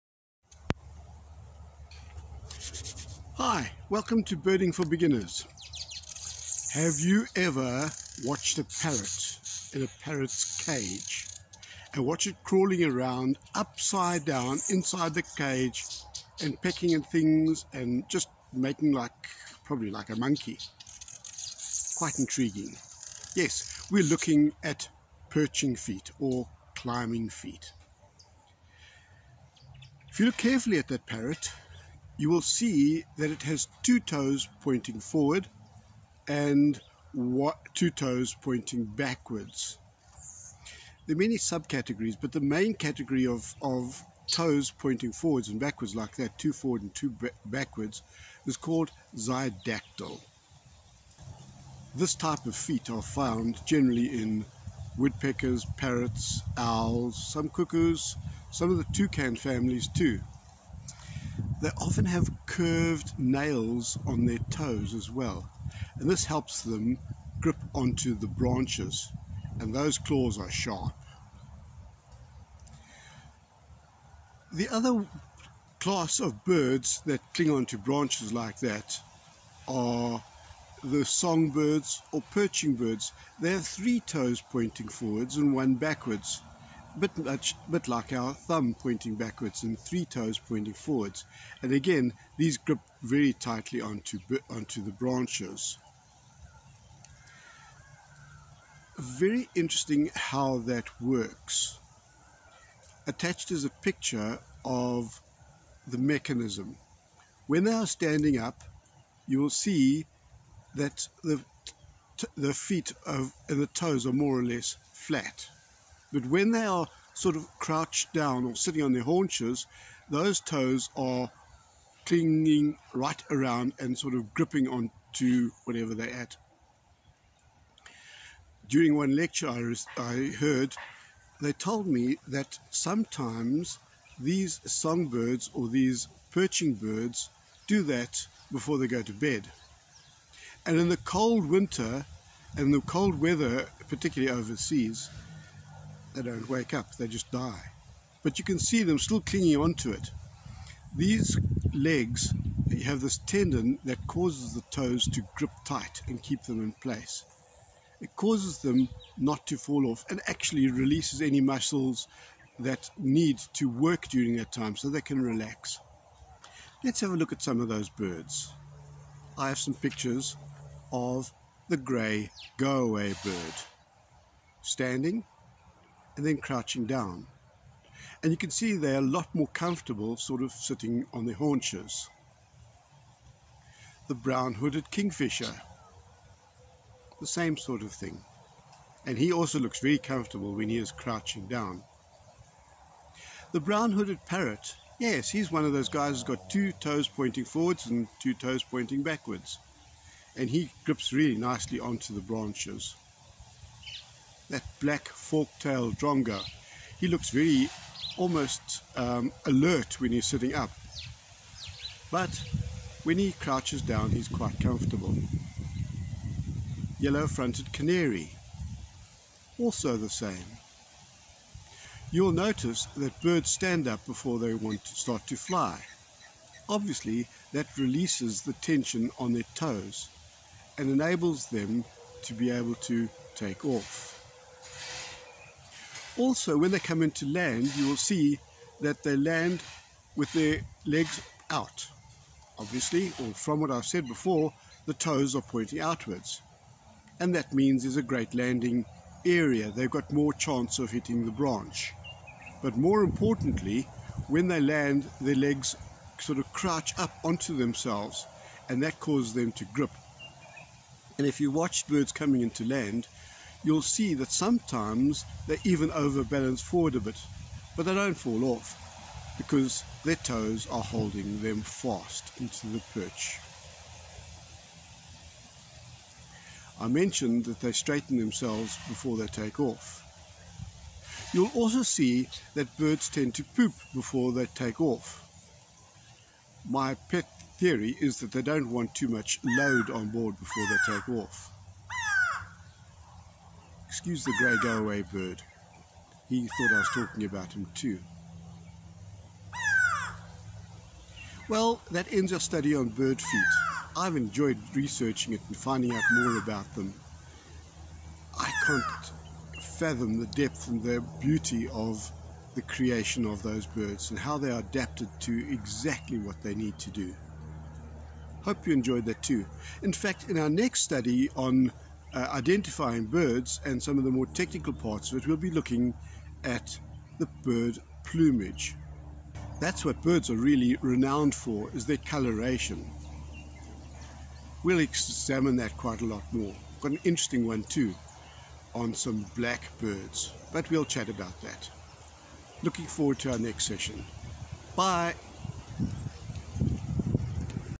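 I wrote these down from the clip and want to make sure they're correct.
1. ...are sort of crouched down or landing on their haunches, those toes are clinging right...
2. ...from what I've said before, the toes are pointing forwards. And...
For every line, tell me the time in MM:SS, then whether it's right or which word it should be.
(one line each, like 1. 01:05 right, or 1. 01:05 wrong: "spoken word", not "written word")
1. 01:56 wrong: "sitting", not "landing"
2. 04:03 wrong: "outwards", not "forwards".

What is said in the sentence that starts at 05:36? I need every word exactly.
Got an interesting one too on some black birds, but we'll chat about that.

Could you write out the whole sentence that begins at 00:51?
This type of feet are found generally in woodpeckers, parrots, owls, some cuckoos, some of the toucan families too.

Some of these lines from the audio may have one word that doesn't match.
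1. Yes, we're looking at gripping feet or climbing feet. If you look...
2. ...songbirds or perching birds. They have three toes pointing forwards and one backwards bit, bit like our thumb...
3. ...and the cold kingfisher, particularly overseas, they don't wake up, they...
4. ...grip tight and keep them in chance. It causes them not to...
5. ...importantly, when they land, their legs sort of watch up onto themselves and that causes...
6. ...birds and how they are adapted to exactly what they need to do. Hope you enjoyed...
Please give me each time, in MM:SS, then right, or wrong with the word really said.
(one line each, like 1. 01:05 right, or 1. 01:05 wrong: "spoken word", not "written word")
1. 00:23 wrong: "perching", not "gripping"
2. 01:21 right
3. 02:22 wrong: "weather", not "kingfisher"
4. 02:35 wrong: "place", not "chance"
5. 04:13 wrong: "crouch", not "watch"
6. 05:13 right.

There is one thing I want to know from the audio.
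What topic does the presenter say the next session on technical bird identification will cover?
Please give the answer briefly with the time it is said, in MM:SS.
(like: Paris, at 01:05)
bird plumage, at 05:27.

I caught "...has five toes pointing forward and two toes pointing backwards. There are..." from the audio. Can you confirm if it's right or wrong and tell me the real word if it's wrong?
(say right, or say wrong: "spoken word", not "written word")
wrong: "two", not "five".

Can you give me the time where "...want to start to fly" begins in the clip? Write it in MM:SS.
03:44.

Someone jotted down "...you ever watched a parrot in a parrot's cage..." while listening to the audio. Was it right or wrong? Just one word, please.
right.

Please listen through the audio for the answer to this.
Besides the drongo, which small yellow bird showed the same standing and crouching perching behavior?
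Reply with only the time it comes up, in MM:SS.
03:36.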